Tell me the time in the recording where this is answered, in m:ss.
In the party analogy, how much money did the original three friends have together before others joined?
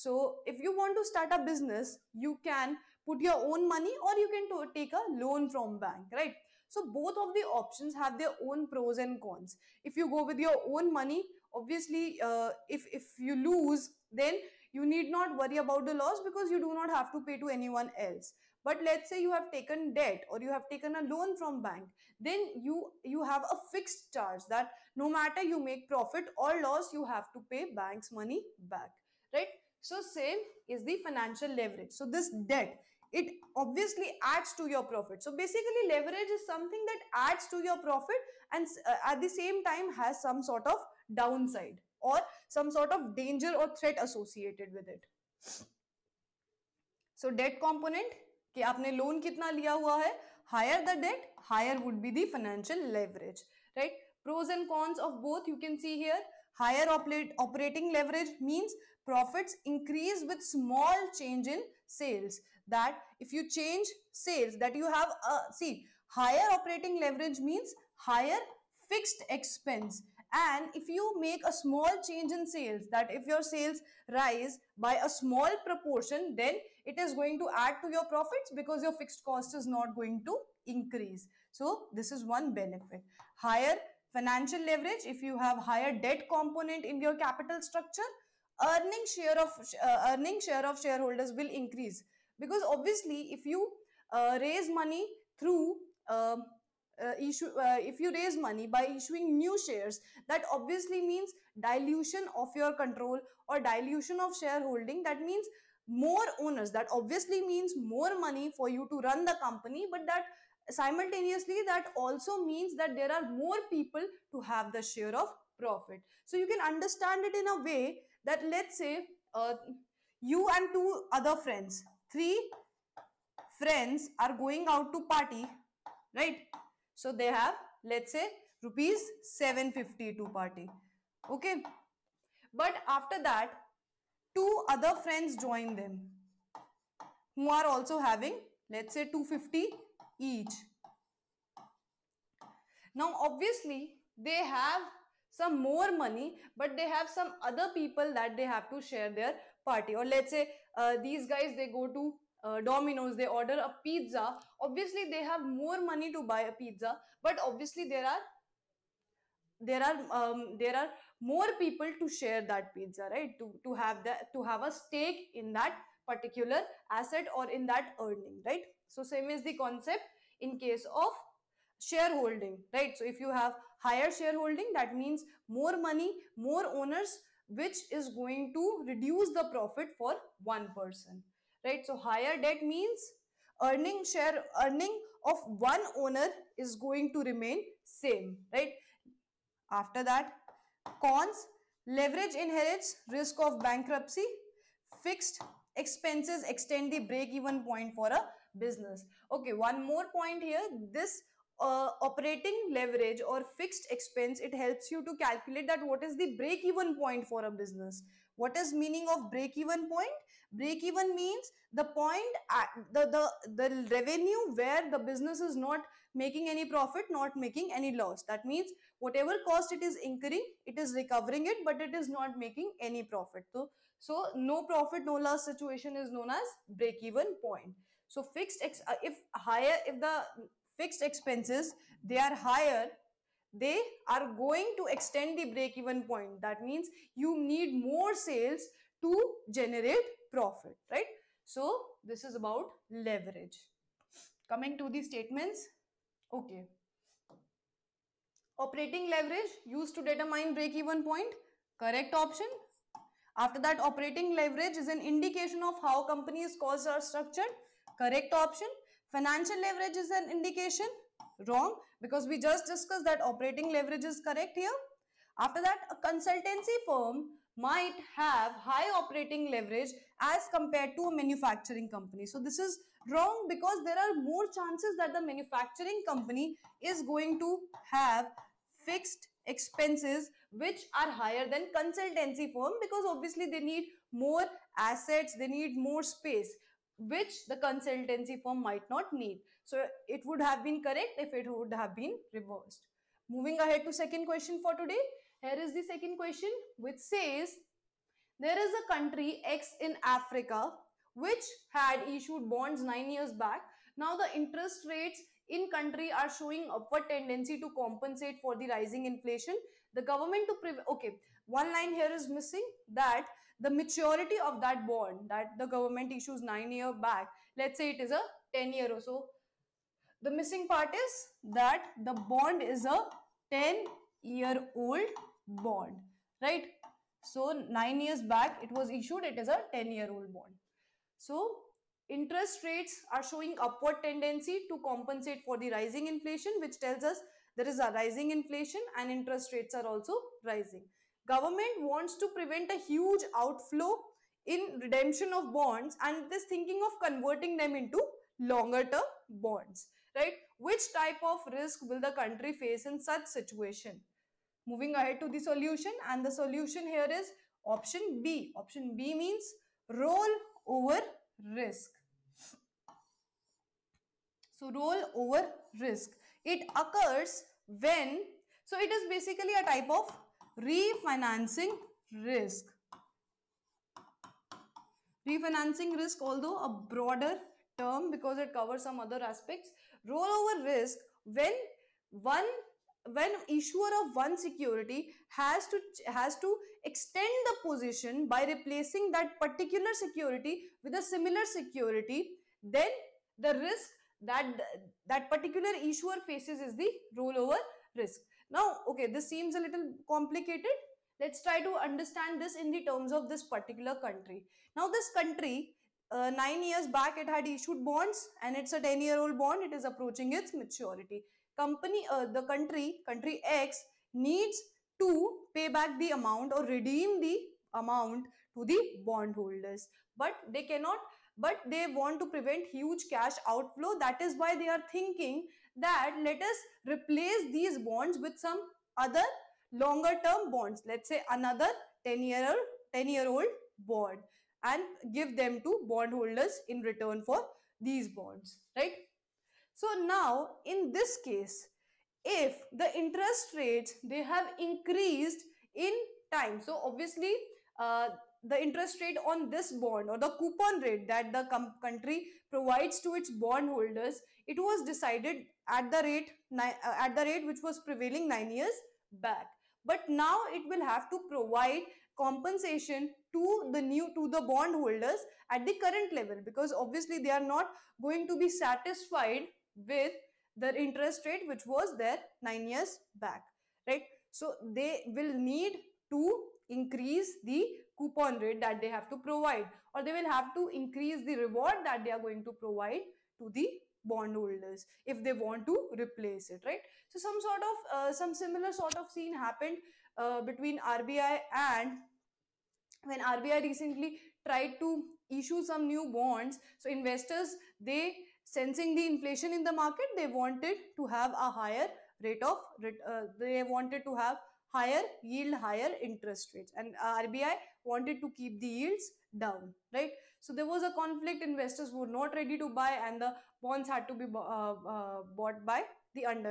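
2:08.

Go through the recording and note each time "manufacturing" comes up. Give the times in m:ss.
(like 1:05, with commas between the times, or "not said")
4:31, 4:35.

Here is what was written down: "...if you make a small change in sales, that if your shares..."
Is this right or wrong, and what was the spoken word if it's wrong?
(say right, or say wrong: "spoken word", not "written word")
wrong: "sales", not "shares".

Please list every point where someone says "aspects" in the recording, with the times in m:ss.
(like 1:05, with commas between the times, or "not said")
6:19.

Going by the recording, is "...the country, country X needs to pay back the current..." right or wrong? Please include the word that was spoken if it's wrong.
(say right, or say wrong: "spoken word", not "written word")
wrong: "amount", not "current".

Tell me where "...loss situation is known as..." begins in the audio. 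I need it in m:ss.
3:45.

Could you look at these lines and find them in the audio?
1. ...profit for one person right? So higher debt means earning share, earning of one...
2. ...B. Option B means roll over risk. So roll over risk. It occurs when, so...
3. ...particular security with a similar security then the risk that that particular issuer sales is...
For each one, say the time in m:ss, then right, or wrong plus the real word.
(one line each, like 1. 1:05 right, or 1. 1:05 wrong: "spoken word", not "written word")
1. 2:59 right
2. 5:58 right
3. 6:29 wrong: "faces", not "sales".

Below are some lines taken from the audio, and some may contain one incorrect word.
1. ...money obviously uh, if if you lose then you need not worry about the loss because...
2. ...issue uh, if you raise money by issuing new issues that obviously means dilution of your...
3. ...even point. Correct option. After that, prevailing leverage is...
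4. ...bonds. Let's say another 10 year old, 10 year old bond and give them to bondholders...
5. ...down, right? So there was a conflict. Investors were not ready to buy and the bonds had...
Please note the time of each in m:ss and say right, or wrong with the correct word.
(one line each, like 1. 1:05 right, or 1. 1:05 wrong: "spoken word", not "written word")
1. 0:10 right
2. 1:37 wrong: "shares", not "issues"
3. 4:10 wrong: "operating", not "prevailing"
4. 7:10 right
5. 8:29 right.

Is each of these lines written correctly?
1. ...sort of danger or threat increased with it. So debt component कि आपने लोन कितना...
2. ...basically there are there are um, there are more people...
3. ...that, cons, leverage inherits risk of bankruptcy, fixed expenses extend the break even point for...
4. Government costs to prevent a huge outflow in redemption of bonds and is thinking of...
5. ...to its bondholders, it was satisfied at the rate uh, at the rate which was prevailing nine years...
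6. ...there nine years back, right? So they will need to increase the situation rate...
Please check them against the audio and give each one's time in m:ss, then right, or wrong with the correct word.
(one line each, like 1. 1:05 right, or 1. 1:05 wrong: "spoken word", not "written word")
1. 0:42 wrong: "associated", not "increased"
2. 2:37 wrong: "obviously", not "basically"
3. 3:10 right
4. 5:41 wrong: "wants", not "costs"
5. 7:33 wrong: "decided", not "satisfied"
6. 7:51 wrong: "coupon", not "situation".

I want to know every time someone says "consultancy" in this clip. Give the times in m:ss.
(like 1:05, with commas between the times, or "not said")
4:26, 4:41, 4:47.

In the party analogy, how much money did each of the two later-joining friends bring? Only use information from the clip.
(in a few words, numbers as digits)
250.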